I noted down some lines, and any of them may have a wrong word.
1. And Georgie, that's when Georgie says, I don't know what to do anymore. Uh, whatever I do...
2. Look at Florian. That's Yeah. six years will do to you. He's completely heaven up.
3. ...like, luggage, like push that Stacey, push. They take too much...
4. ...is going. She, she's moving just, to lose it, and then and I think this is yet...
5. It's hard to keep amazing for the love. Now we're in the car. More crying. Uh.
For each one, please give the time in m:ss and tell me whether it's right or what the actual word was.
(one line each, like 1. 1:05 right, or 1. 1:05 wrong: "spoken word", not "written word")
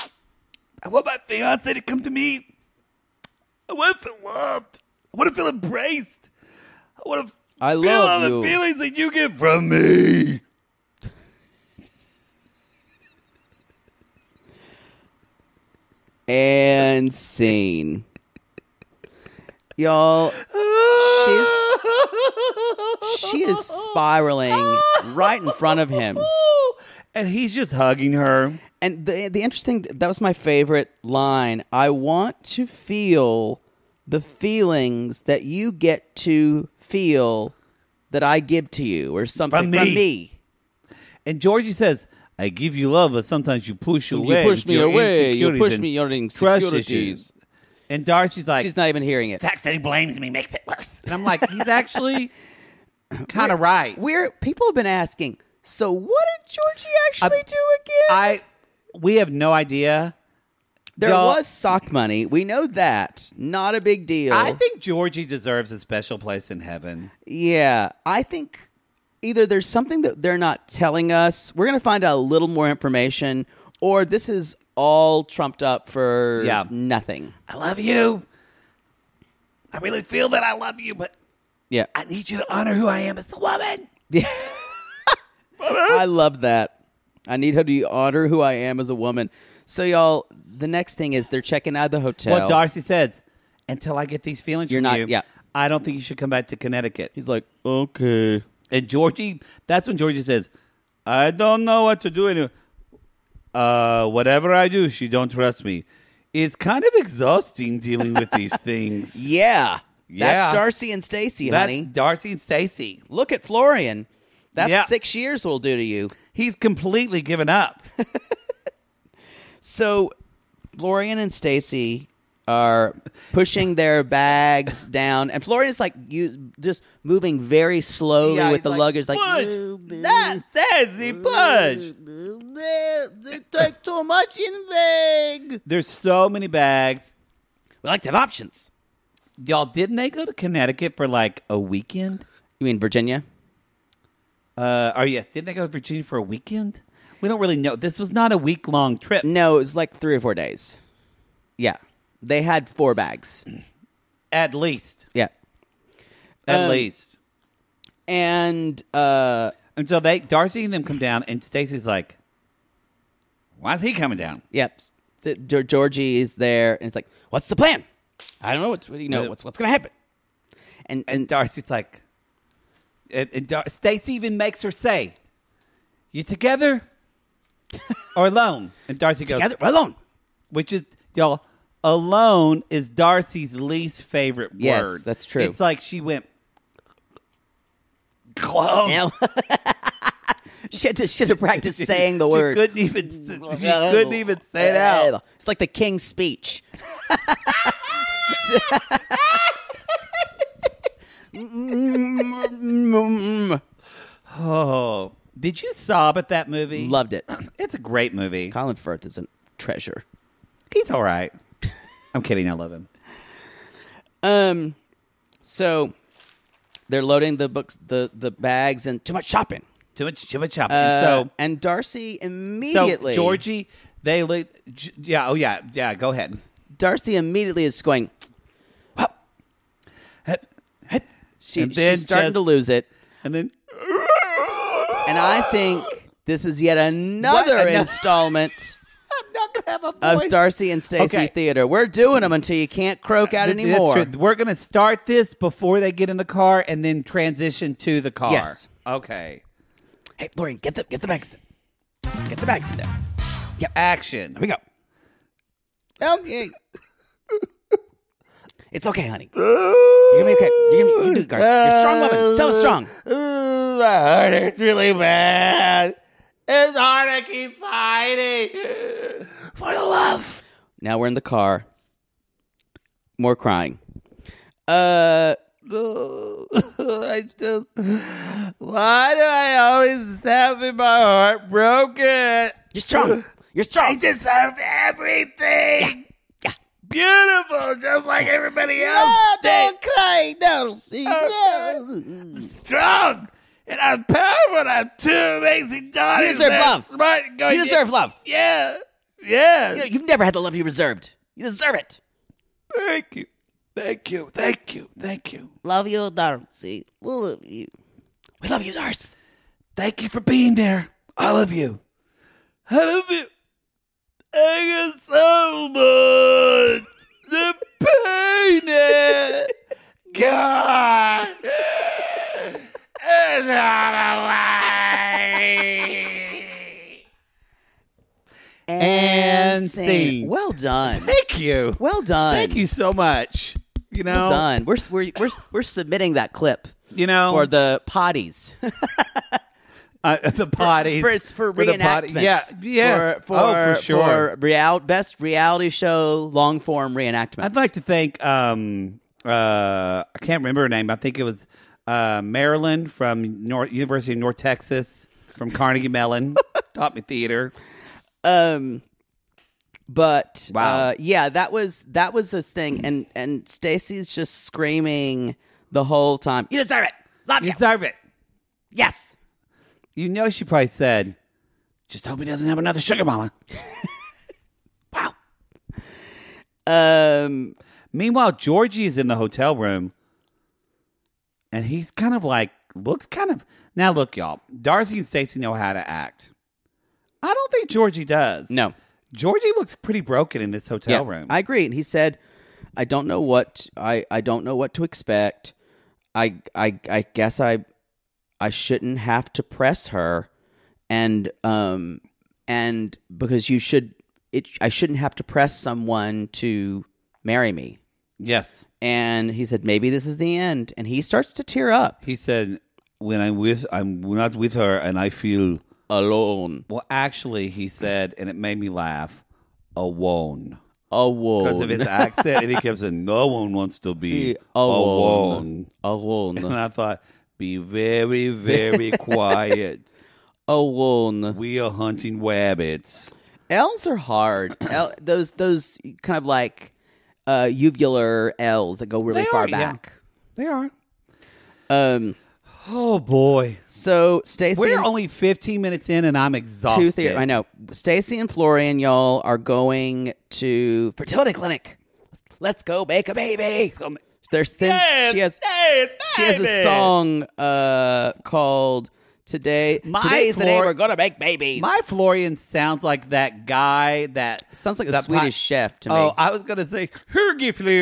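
1. 1:38 right
2. 1:53 wrong: "given", not "heaven"
3. 2:08 right
4. 3:47 wrong: "starting", not "moving"
5. 4:26 wrong: "fighting", not "amazing".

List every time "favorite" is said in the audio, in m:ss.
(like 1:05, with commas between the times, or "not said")
0:30, 3:04.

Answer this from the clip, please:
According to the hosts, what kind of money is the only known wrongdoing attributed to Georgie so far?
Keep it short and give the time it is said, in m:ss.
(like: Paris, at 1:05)
Sock money, at 1:01.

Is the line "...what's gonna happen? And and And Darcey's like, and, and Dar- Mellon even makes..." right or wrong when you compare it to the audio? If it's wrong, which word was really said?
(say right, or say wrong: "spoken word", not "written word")
wrong: "Stacey", not "Mellon".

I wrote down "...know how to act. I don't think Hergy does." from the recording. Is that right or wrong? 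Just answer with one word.
wrong.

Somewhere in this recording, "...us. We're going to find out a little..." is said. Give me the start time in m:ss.
1:11.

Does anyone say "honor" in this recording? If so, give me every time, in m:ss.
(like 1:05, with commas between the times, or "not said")
1:22, 1:27.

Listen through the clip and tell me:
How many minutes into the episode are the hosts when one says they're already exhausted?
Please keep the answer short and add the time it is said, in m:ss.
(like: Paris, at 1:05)
15, at 7:25.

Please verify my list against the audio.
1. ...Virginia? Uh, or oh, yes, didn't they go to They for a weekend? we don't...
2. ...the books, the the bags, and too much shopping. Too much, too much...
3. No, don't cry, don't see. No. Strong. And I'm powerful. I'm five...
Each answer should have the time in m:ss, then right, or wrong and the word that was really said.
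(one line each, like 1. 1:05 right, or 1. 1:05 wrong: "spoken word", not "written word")
1. 2:22 wrong: "Virginia", not "They"
2. 3:37 right
3. 4:49 wrong: "two", not "five".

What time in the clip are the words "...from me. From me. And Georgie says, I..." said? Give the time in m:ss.
0:39.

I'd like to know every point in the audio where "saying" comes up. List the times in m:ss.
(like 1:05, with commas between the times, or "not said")
3:11, 7:02.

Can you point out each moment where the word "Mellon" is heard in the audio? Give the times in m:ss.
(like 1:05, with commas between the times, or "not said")
5:55.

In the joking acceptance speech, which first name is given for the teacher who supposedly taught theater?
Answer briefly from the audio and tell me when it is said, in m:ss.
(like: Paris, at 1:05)
Marilyn, at 5:52.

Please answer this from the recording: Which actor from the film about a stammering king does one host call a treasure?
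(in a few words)
Colin Firth.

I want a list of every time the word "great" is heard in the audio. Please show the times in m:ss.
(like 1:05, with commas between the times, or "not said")
3:27, 4:21.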